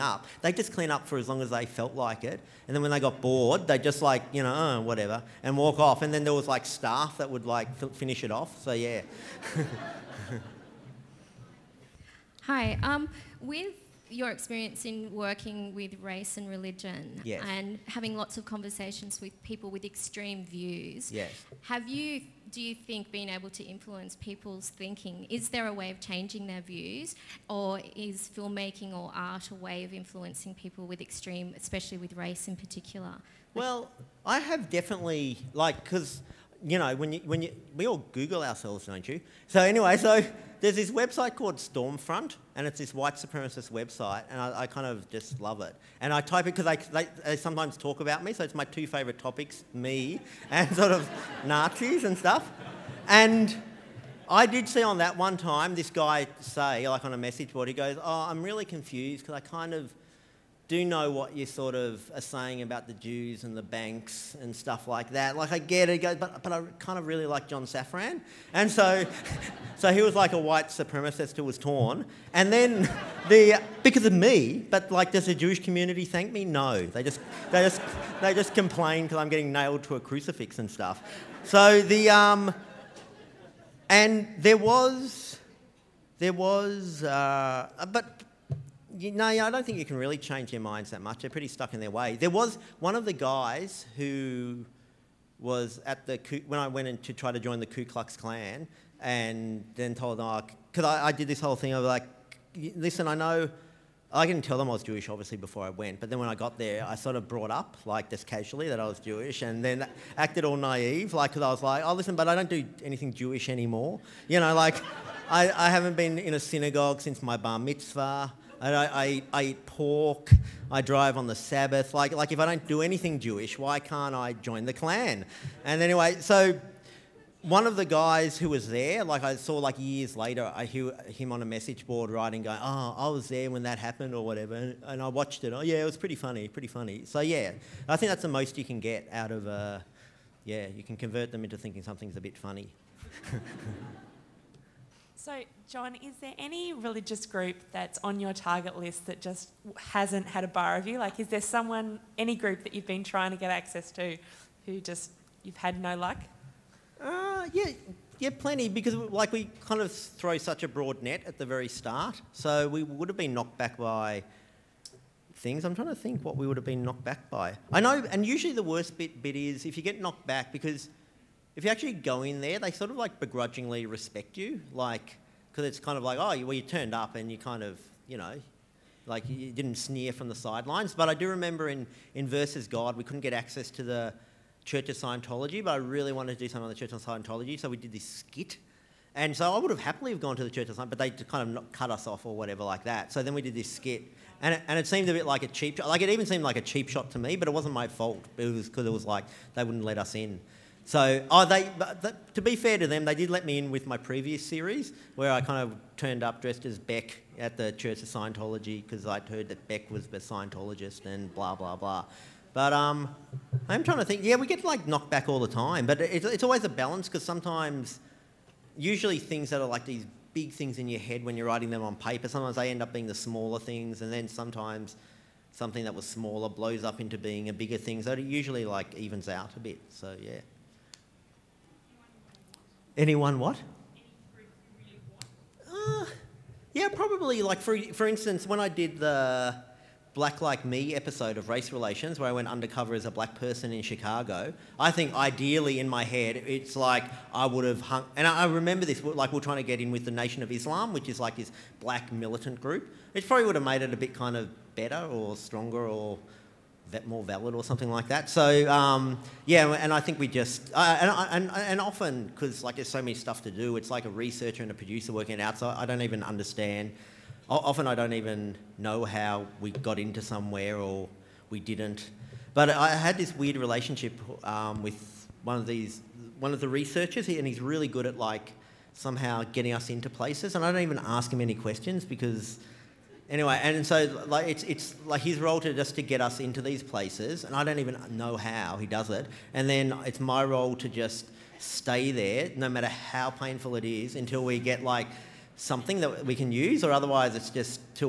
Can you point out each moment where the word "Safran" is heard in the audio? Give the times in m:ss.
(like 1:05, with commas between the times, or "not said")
1:07.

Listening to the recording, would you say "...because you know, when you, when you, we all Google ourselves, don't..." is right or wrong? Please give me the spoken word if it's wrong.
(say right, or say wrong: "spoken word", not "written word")
right.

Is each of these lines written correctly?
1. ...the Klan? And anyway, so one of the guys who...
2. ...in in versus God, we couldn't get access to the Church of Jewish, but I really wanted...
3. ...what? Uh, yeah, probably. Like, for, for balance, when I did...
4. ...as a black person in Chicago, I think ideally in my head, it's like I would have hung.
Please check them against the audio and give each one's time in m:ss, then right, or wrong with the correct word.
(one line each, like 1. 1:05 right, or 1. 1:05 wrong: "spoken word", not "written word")
1. 2:04 right
2. 3:01 wrong: "Scientology", not "Jewish"
3. 3:53 wrong: "instance", not "balance"
4. 4:02 right.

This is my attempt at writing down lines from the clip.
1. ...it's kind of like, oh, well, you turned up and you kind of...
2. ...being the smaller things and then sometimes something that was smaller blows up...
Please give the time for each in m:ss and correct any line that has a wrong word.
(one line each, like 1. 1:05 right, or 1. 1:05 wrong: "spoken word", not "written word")
1. 2:55 right
2. 3:42 right.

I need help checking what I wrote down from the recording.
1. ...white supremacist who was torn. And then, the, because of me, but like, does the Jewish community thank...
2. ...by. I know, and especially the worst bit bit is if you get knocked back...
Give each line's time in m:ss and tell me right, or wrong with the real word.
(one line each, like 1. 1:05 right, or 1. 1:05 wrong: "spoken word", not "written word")
1. 1:10 right
2. 2:47 wrong: "usually", not "especially".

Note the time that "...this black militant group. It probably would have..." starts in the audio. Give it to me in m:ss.
4:11.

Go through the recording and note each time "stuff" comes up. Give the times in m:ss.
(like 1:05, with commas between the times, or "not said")
0:52, 1:04, 1:20, 4:23.